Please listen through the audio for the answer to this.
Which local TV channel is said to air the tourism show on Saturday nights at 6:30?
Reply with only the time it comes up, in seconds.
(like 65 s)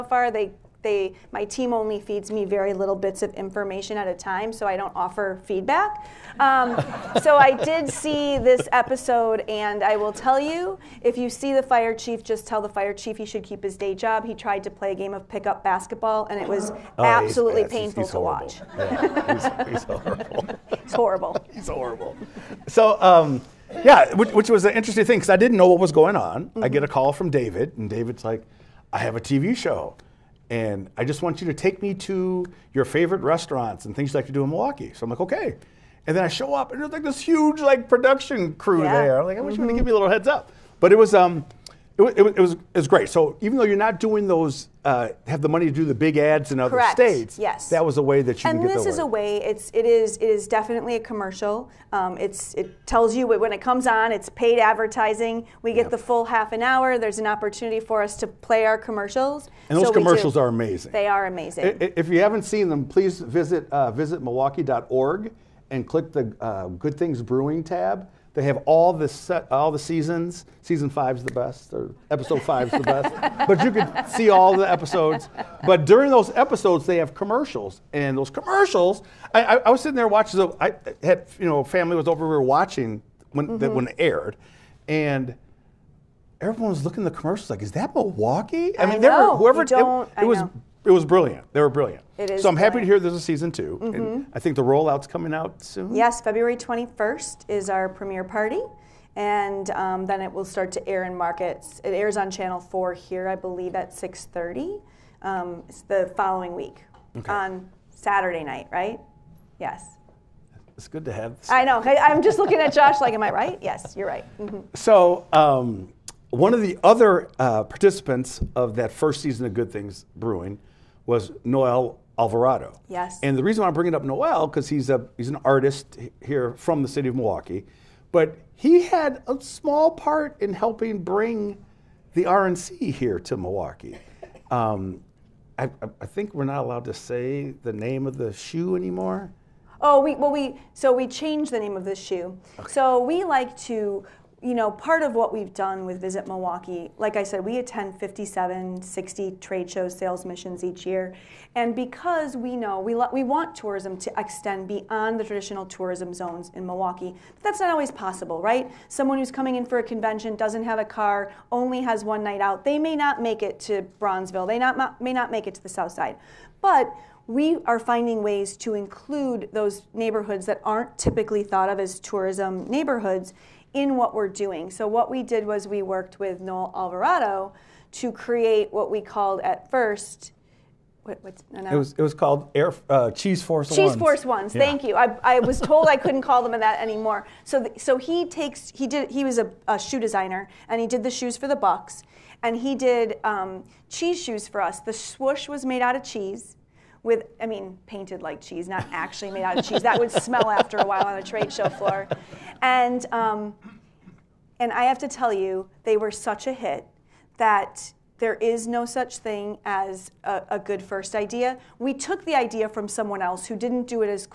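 102 s.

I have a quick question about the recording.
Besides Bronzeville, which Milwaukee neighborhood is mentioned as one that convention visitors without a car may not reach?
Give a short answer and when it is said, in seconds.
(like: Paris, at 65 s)
South Side, at 165 s.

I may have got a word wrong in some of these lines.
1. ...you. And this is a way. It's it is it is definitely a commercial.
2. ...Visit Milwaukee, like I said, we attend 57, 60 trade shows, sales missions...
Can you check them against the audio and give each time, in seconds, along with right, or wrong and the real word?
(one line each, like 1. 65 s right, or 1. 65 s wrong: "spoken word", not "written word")
1. 48 s right
2. 146 s right.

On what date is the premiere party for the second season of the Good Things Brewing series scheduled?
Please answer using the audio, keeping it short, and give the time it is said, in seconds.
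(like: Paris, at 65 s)
February 21st, at 96 s.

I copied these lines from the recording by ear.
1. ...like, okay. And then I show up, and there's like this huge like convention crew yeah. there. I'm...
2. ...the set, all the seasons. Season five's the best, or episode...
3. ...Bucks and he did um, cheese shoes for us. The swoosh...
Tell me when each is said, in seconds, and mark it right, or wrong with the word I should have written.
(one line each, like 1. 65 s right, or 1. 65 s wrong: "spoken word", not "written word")
1. 35 s wrong: "production", not "convention"
2. 68 s right
3. 191 s right.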